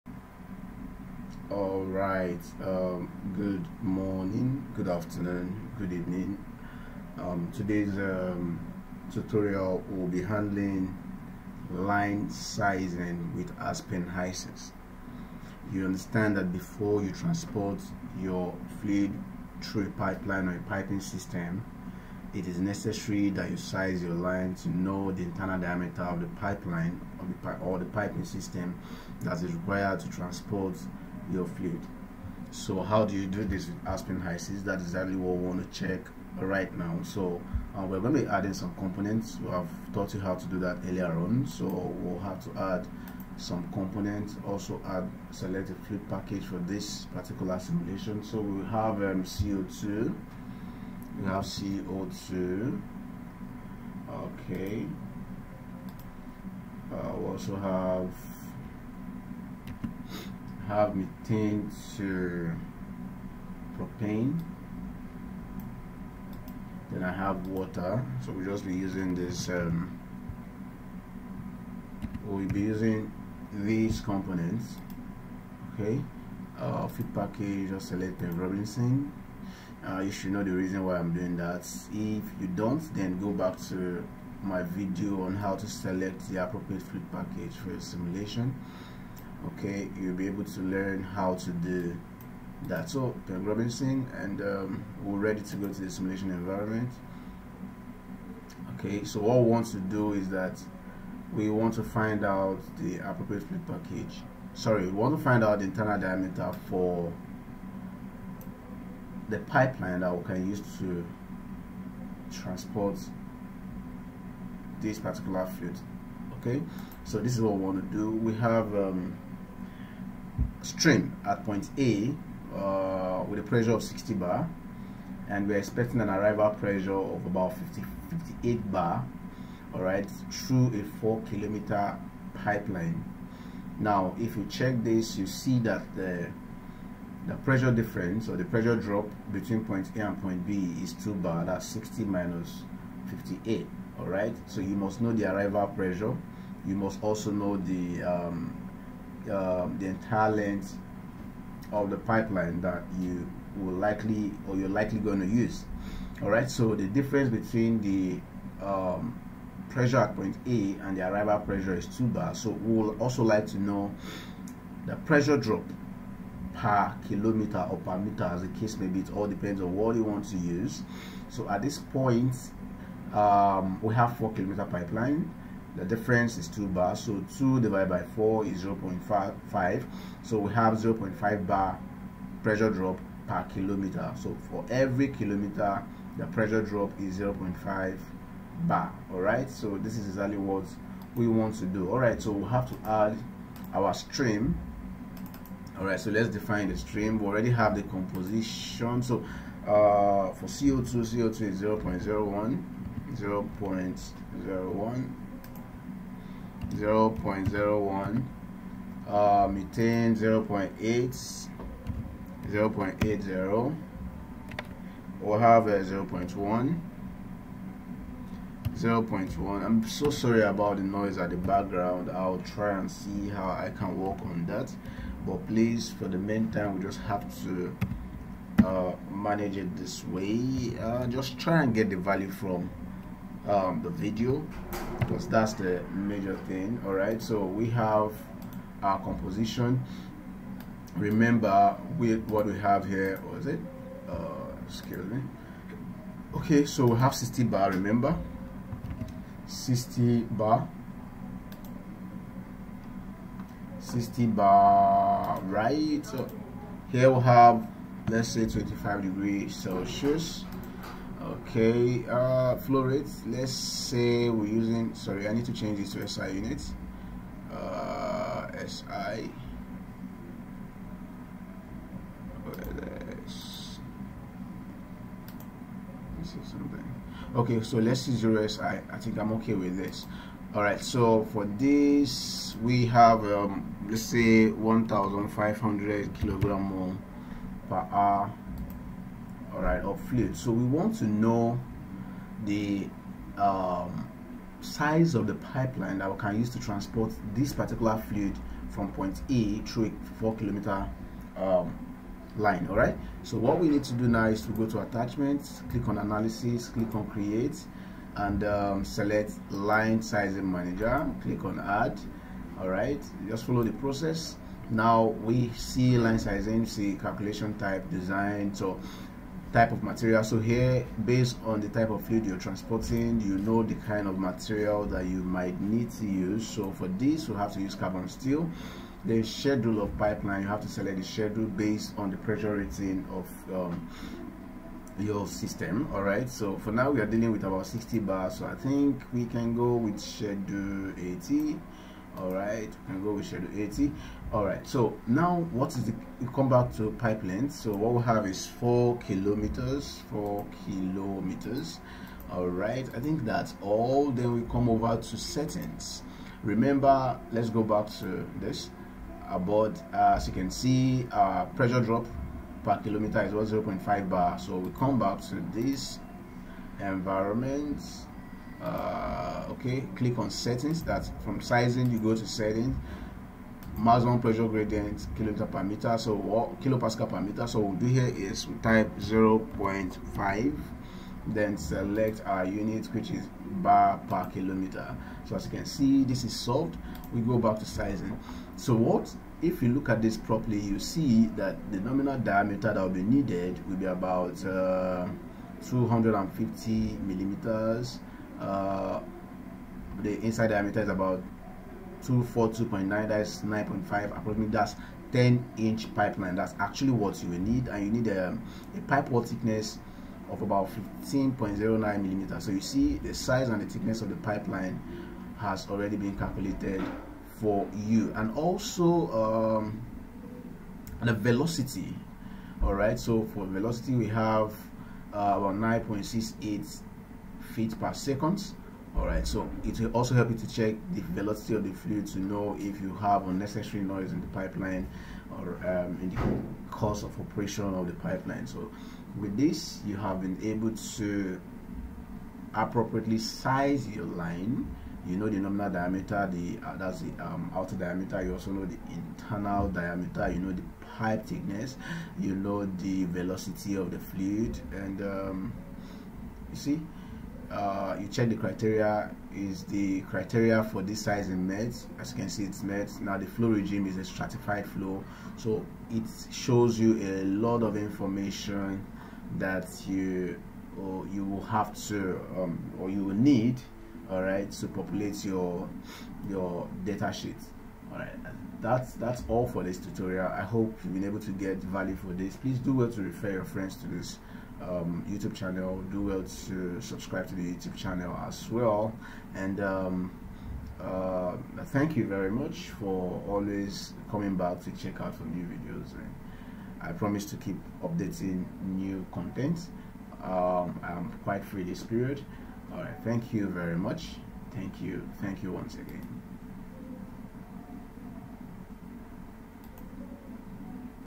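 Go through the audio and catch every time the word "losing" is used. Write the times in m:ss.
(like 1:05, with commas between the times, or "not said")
not said.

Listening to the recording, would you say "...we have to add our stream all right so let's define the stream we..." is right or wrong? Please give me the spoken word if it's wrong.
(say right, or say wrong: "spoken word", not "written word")
right.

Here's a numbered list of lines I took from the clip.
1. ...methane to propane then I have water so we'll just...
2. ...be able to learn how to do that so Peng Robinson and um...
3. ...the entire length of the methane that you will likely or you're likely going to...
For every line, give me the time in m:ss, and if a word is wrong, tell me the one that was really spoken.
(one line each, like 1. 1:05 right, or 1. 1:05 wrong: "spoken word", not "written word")
1. 1:00 right
2. 1:30 right
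3. 2:29 wrong: "pipeline", not "methane".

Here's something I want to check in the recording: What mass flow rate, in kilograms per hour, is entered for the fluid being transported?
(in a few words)
1500.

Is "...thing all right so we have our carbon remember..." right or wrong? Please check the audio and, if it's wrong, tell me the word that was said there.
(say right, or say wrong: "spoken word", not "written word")
wrong: "composition", not "carbon".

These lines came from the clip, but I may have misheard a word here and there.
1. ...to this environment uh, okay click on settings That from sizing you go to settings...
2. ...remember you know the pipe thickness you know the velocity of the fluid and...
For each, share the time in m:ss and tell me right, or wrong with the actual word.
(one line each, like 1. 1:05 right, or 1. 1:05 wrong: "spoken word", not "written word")
1. 6:05 right
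2. 7:29 wrong: "diameter", not "remember".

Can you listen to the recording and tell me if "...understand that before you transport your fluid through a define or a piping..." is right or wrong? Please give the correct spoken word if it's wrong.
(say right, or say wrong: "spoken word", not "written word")
wrong: "pipeline", not "define".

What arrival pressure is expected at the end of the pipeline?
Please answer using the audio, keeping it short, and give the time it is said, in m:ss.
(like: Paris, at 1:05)
58 bar, at 2:08.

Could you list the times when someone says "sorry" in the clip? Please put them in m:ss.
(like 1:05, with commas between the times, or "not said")
1:44, 3:40, 4:24.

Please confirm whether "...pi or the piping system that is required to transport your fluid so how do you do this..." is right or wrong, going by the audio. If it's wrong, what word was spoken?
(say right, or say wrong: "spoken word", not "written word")
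right.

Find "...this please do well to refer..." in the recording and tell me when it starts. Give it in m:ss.
8:02.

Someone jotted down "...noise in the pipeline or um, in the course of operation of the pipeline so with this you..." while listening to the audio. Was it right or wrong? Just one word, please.
right.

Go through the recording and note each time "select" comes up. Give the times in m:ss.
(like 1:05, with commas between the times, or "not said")
0:45, 1:17, 1:25, 5:08, 5:30, 6:21.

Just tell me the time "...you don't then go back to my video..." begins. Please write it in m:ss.
1:22.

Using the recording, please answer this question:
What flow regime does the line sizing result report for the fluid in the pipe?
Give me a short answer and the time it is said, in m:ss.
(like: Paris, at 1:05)
stratified flow, at 7:44.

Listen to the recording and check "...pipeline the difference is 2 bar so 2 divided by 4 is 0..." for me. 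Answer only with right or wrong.
right.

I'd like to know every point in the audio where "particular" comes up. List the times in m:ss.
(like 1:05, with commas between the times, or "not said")
0:47, 1:54, 4:57.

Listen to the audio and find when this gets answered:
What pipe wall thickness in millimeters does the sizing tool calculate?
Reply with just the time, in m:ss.
6:51.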